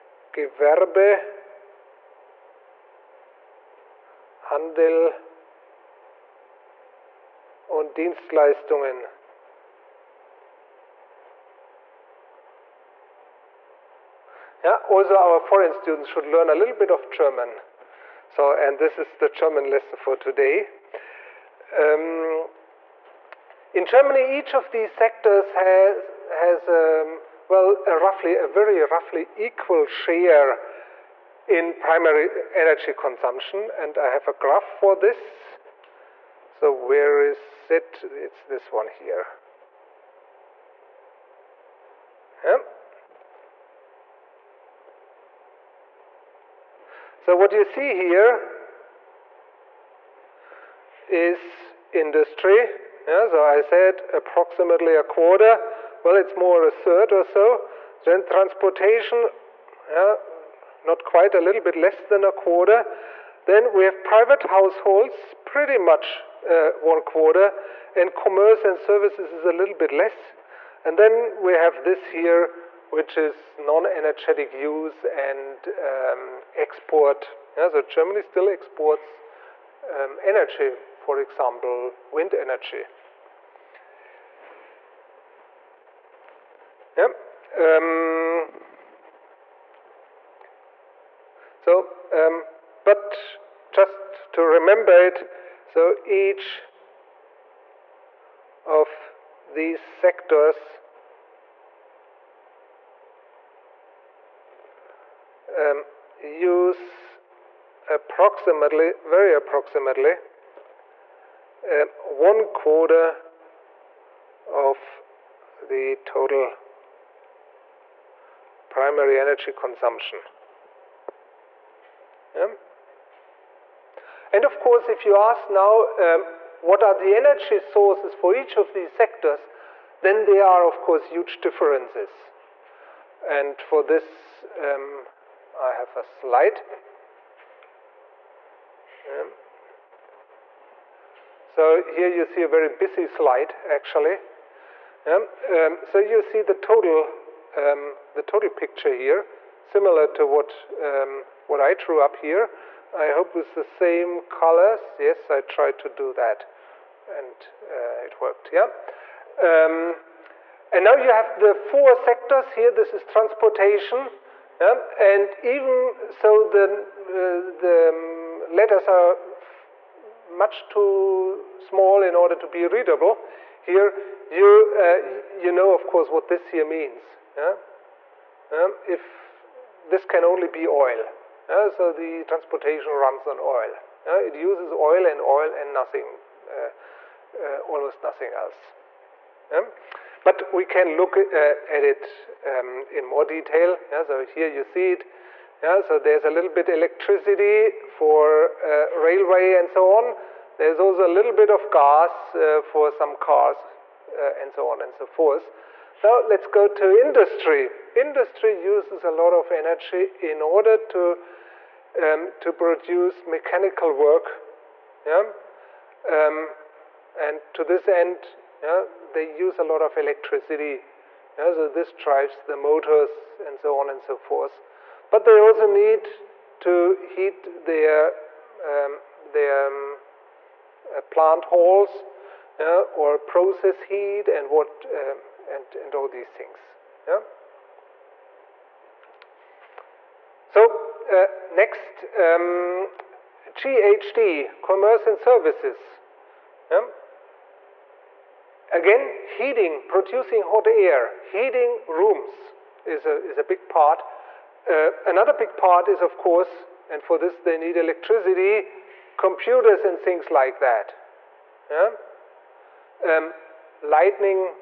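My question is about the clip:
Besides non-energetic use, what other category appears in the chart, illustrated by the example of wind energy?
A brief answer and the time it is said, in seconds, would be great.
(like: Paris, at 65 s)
export, at 76 s.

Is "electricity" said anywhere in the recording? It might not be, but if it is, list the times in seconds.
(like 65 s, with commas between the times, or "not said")
196 s, 219 s, 257 s.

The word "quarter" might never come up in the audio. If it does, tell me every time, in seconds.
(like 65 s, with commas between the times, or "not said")
55 s, 62 s, 67 s, 112 s.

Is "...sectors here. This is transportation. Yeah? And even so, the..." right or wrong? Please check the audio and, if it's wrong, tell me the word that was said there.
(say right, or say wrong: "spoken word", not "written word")
right.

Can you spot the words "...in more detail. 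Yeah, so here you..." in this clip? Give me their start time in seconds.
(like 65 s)
192 s.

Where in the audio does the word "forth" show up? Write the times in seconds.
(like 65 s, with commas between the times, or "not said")
205 s, 224 s.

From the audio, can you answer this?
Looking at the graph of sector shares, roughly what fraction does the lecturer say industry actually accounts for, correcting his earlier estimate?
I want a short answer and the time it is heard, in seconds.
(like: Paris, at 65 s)
a third, at 56 s.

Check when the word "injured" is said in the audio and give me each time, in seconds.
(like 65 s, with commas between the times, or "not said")
not said.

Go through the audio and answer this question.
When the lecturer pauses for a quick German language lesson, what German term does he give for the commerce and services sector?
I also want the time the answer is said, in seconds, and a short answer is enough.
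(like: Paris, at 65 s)
Gewerbe, Handel, und Dienstleistungen, at 0 s.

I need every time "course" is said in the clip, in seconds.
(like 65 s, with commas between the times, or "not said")
124 s, 130 s, 175 s, 256 s.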